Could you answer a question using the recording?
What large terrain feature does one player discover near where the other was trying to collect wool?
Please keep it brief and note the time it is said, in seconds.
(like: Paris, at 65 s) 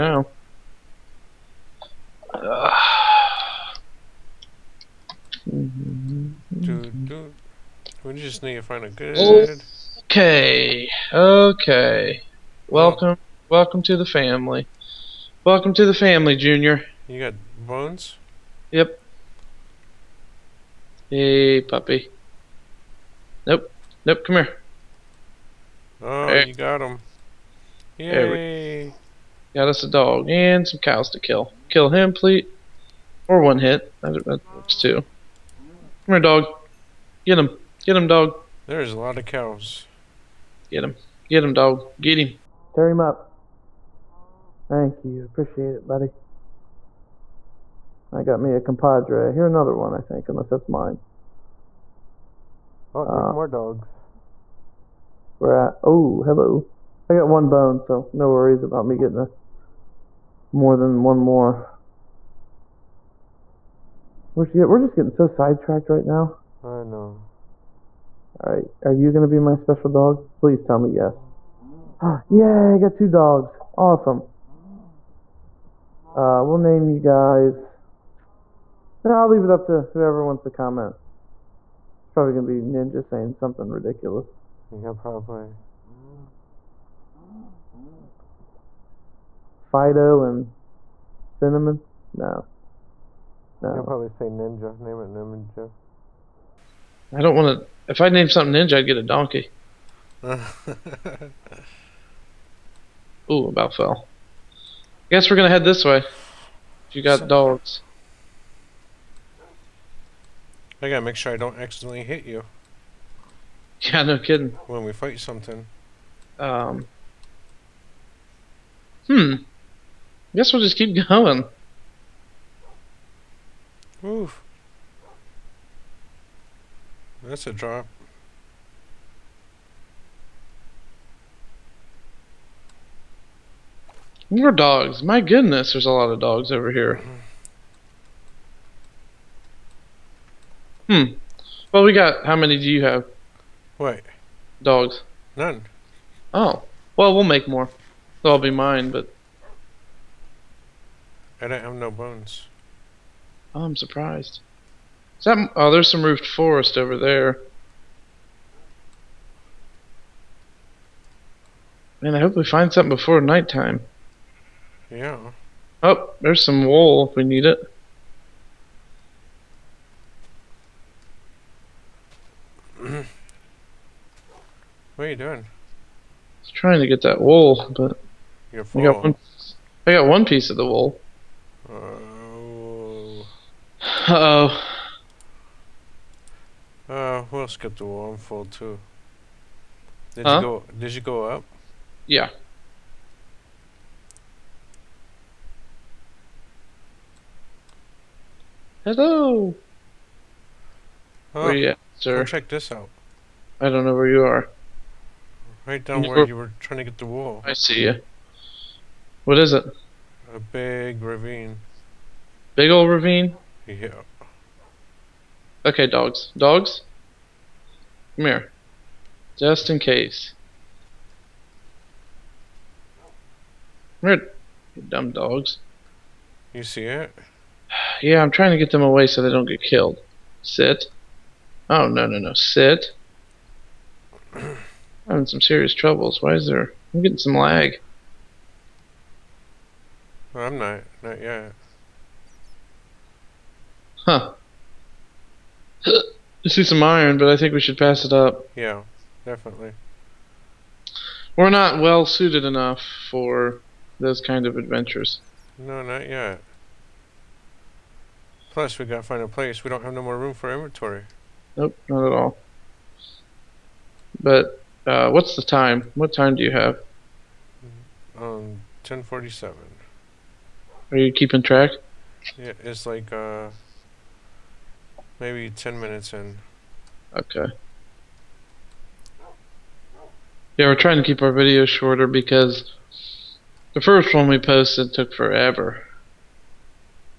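A big ravine, at 210 s.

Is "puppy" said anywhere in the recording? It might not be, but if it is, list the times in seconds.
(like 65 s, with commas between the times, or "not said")
21 s.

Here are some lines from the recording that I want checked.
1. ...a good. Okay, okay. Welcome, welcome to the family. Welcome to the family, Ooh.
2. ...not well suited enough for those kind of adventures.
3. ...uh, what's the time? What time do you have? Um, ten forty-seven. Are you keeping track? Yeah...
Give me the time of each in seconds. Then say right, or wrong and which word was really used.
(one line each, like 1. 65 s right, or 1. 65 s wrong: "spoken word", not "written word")
1. 8 s wrong: "Junior", not "Ooh"
2. 251 s right
3. 264 s right.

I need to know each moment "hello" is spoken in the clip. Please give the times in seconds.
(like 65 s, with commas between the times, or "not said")
56 s, 198 s.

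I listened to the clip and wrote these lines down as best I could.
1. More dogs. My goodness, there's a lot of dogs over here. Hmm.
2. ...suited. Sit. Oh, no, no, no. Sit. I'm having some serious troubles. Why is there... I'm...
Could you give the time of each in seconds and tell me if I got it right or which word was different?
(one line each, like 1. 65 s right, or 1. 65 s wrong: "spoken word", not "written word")
1. 134 s right
2. 229 s wrong: "killed", not "suited".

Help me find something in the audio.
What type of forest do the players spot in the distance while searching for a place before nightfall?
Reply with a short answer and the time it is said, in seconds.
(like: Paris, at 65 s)
Roofed forest, at 156 s.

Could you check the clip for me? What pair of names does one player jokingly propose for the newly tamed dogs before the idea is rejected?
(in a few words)
Fido and Cinnamon.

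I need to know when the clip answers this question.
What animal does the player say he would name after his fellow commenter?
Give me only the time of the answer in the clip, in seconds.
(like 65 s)
99 s.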